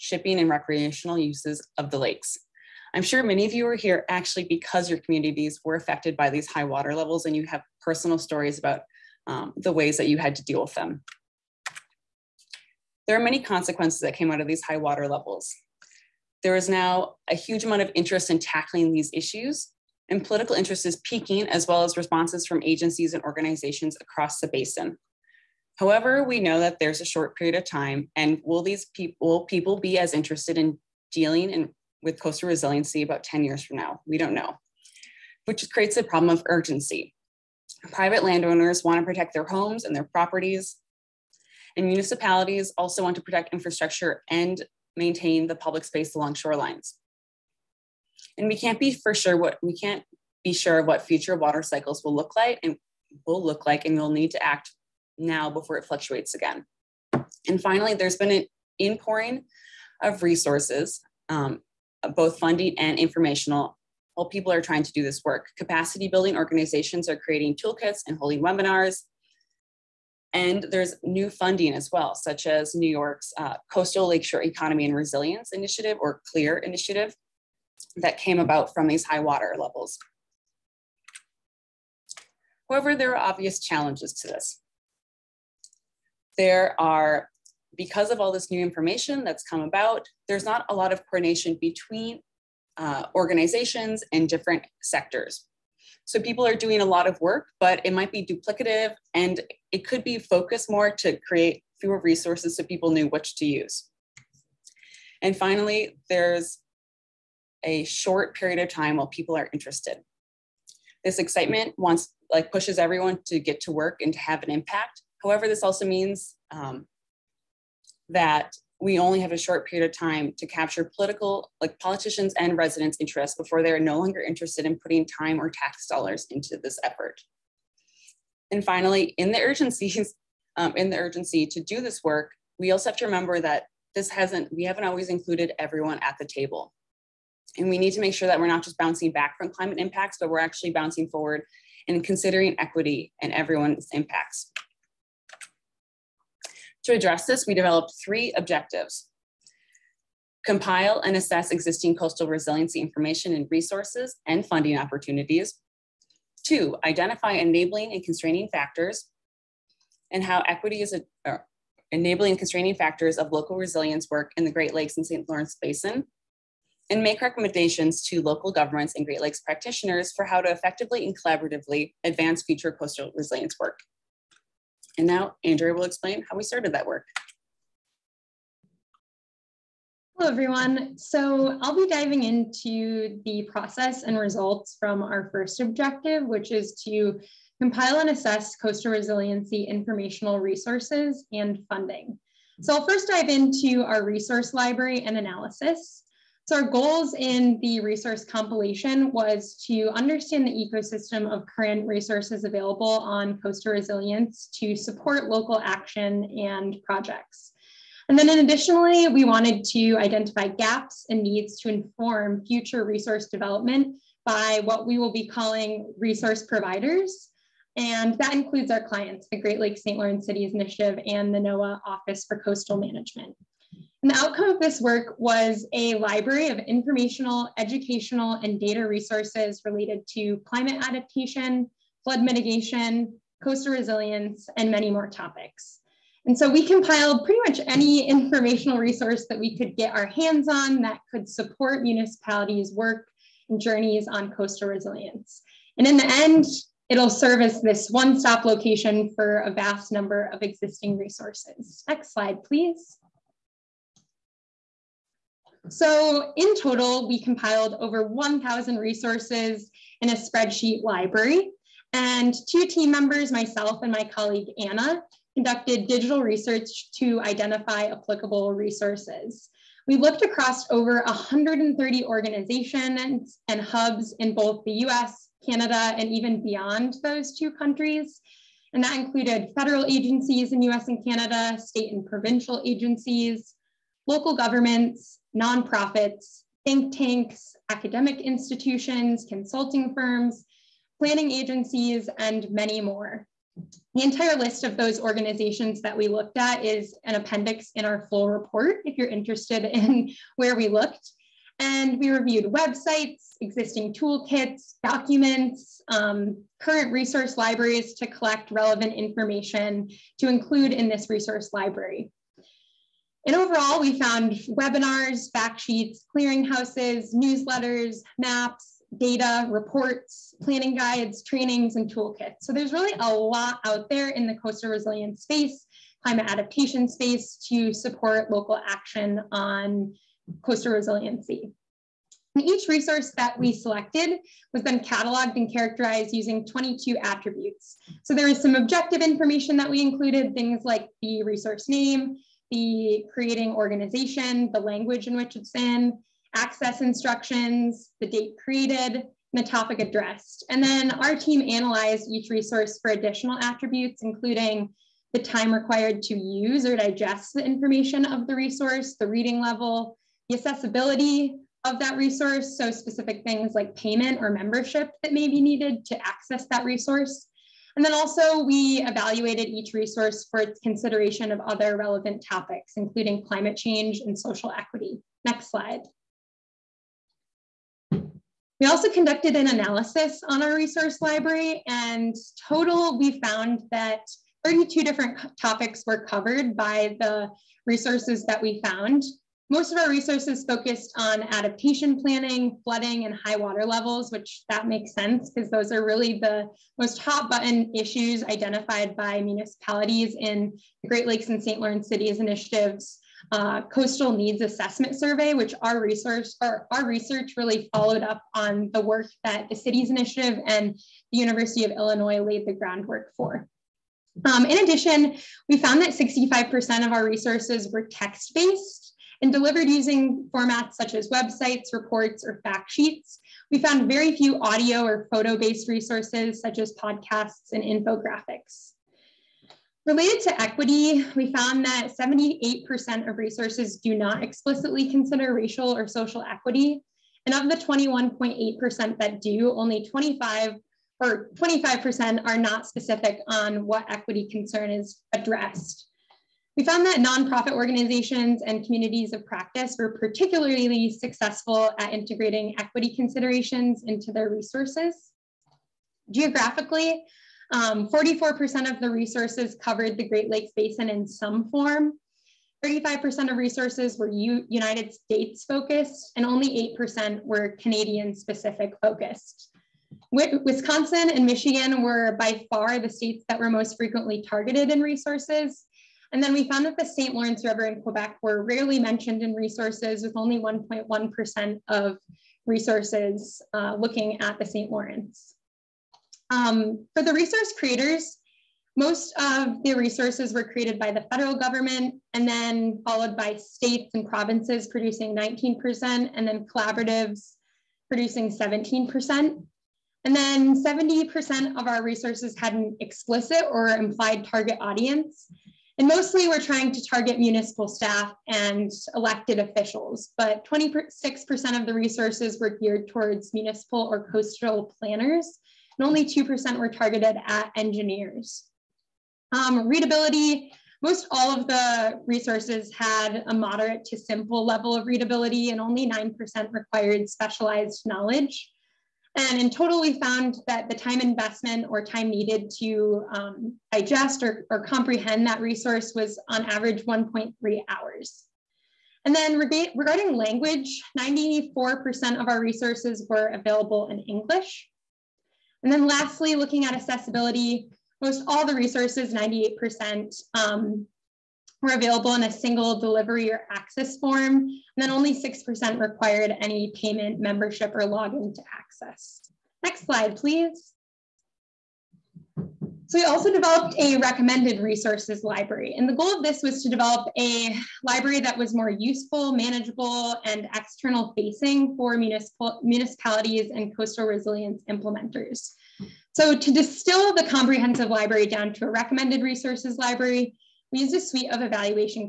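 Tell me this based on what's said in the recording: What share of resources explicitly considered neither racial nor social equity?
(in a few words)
78%.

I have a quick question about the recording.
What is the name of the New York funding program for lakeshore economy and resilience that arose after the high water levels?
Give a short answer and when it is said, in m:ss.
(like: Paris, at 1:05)
CLEAR initiative, at 1:16.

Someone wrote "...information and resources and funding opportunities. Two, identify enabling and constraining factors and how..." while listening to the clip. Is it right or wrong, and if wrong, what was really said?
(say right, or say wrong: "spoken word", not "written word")
right.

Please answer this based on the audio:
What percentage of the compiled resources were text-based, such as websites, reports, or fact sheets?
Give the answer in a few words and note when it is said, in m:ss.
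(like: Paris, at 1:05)
65%, at 6:55.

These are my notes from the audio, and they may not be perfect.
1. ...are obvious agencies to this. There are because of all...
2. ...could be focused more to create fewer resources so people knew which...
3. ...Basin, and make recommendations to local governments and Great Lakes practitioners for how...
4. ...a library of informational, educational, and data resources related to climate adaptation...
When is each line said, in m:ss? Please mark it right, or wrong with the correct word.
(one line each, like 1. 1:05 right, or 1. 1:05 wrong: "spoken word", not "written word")
1. 1:23 wrong: "challenges", not "agencies"
2. 1:39 right
3. 2:45 right
4. 3:45 right.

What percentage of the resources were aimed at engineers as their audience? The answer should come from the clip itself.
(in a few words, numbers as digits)
2%.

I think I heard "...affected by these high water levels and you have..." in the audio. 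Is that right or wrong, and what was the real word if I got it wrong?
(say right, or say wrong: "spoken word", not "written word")
right.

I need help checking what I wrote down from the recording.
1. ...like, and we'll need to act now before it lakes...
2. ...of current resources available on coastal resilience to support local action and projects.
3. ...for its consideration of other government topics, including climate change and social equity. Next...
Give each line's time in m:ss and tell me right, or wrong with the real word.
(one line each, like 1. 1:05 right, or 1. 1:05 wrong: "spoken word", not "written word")
1. 0:53 wrong: "fluctuates", not "lakes"
2. 3:21 right
3. 6:10 wrong: "relevant", not "government".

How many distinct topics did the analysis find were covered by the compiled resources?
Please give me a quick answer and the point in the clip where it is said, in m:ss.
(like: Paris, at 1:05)
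32, at 6:24.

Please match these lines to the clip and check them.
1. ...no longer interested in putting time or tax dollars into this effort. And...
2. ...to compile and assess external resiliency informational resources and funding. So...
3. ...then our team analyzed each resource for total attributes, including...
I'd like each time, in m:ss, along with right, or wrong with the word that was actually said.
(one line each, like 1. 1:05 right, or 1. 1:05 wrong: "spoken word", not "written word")
1. 2:03 right
2. 3:06 wrong: "coastal", not "external"
3. 5:50 wrong: "additional", not "total".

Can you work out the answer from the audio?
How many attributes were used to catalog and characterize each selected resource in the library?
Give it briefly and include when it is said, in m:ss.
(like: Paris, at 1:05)
22, at 5:36.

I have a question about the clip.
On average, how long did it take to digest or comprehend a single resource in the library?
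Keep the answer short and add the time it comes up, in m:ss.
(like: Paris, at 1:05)
1.3 hours, at 8:56.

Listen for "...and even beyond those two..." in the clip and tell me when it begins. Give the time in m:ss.
4:35.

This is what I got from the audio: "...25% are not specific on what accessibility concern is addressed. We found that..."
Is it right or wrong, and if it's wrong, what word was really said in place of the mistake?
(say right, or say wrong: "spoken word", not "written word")
wrong: "equity", not "accessibility".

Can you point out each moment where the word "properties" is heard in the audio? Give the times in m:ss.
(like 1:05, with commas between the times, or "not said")
0:40.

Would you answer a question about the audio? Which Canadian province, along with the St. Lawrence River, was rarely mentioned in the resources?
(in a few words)
Quebec.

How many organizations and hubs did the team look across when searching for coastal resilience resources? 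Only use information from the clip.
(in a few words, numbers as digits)
over 130.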